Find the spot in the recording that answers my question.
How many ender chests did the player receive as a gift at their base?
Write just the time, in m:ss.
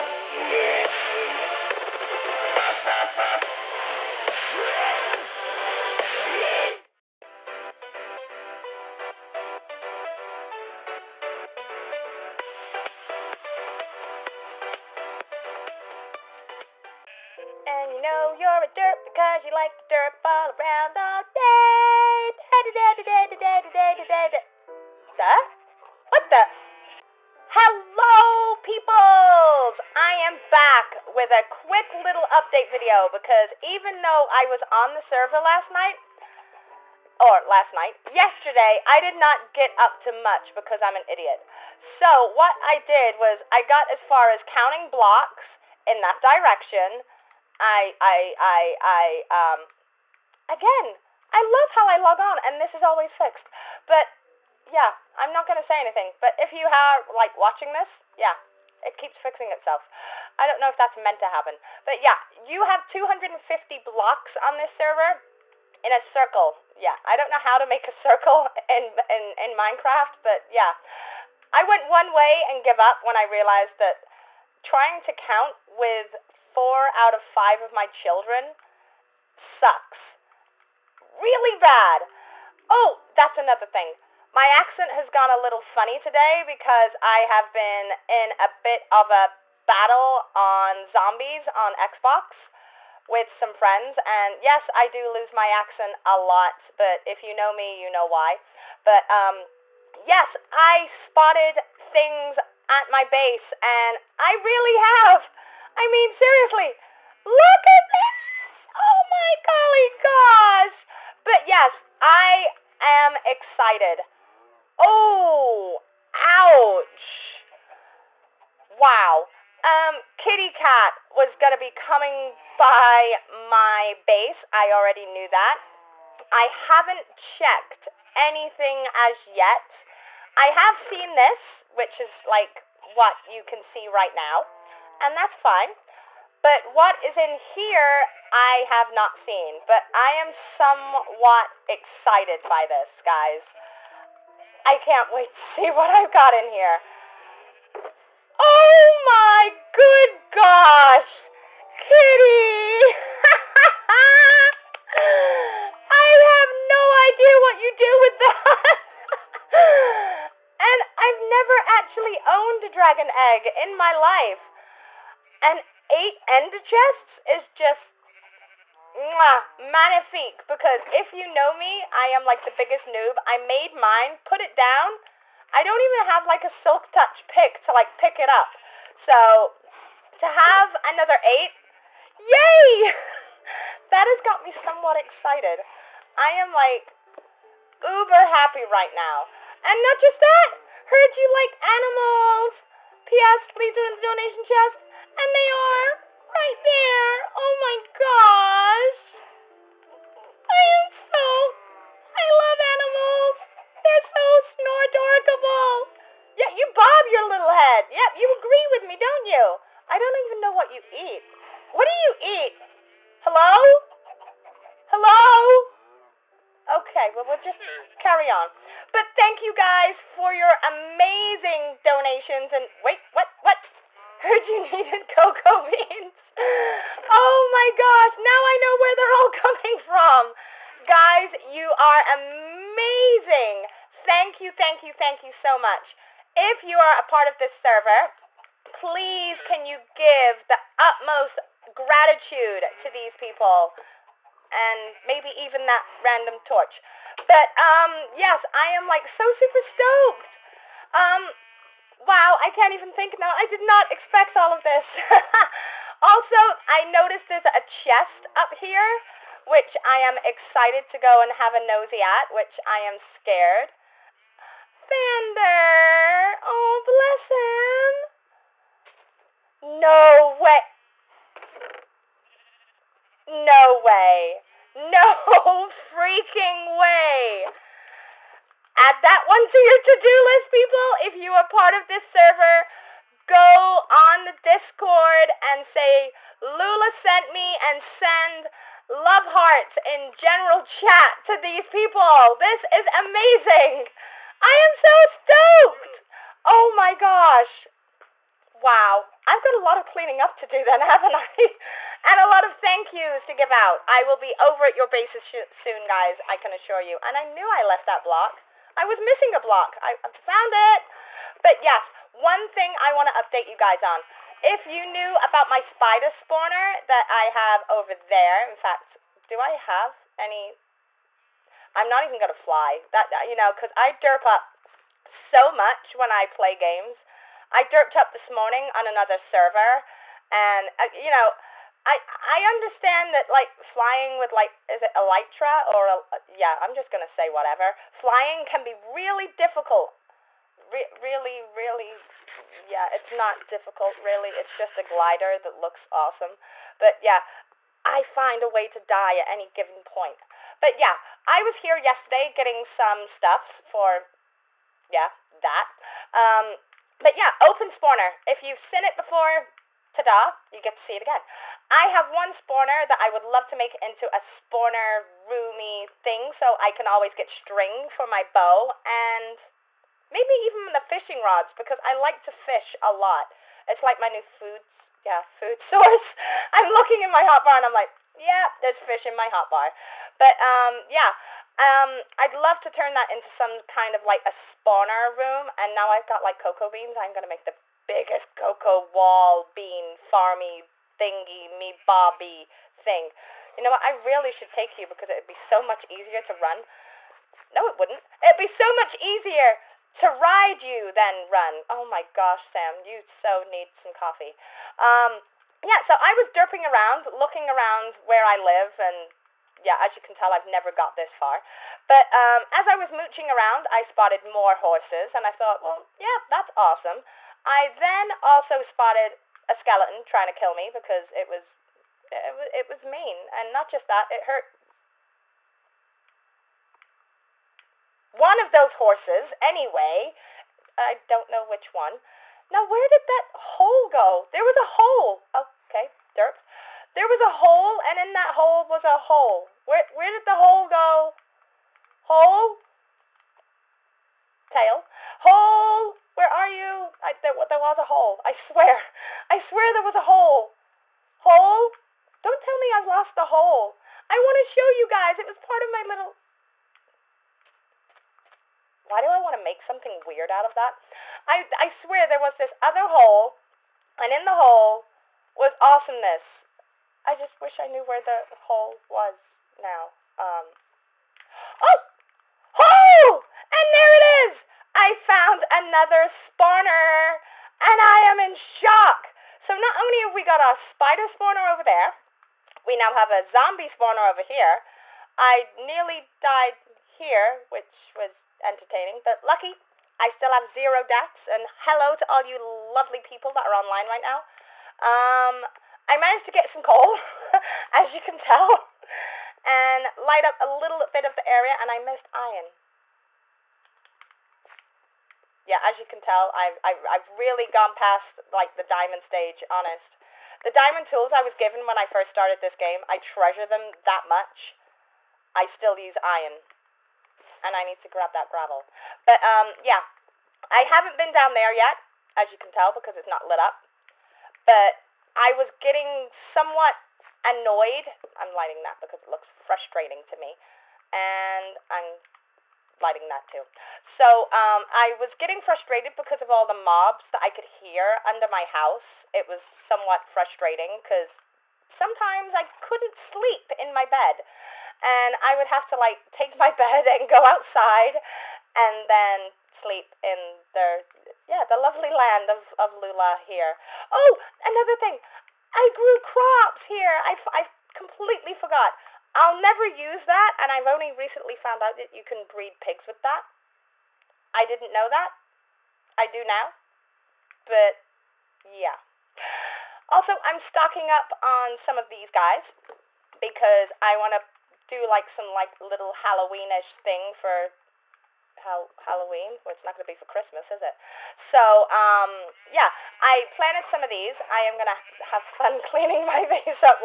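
2:45.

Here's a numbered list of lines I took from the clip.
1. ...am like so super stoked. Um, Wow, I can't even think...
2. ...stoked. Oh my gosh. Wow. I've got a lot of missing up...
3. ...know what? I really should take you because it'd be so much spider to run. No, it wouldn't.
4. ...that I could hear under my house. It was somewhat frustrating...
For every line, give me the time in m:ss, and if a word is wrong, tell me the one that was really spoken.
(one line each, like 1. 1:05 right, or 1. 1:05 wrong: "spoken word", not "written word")
1. 4:08 right
2. 4:55 wrong: "cleaning", not "missing"
3. 6:33 wrong: "easier", not "spider"
4. 8:57 right.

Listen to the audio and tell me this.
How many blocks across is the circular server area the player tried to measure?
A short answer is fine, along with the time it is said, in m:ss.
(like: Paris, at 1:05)
250 blocks, at 1:02.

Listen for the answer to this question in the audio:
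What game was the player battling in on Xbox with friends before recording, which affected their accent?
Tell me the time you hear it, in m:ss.
1:30.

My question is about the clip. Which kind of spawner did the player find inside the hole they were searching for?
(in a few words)
zombie spawner.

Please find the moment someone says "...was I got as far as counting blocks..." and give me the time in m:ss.
0:43.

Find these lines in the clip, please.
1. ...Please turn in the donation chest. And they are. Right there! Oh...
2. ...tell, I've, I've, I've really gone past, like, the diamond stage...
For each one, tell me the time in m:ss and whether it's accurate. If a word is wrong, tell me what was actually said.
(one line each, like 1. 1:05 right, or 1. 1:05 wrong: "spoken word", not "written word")
1. 3:13 right
2. 8:25 right.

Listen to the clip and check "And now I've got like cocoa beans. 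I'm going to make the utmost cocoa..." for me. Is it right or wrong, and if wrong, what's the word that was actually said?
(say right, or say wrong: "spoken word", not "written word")
wrong: "biggest", not "utmost".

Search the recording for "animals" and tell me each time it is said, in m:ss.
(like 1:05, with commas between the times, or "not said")
3:11, 3:22.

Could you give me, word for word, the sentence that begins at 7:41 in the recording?
I, I swear there was this other hole, and in the hole was awesomeness.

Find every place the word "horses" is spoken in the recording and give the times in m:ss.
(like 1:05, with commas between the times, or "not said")
6:54, 7:08.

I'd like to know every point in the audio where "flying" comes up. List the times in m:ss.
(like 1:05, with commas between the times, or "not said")
5:33, 5:37.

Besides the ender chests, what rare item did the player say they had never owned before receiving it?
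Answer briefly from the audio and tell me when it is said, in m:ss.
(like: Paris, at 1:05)
dragon egg, at 2:42.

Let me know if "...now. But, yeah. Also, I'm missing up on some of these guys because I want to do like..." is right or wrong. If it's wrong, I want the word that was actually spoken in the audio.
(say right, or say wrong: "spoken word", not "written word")
wrong: "stocking", not "missing".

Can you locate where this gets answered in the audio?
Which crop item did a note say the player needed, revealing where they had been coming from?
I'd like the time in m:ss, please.
3:45.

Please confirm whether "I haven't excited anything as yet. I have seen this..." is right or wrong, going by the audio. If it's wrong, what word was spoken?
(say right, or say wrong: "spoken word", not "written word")
wrong: "checked", not "excited".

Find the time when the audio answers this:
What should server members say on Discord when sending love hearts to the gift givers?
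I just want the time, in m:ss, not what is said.
4:46.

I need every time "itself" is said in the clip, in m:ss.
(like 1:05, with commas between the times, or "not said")
0:59.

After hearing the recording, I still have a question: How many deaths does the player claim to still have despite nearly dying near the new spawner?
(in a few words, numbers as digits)
0.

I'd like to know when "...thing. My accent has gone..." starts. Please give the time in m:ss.
1:23.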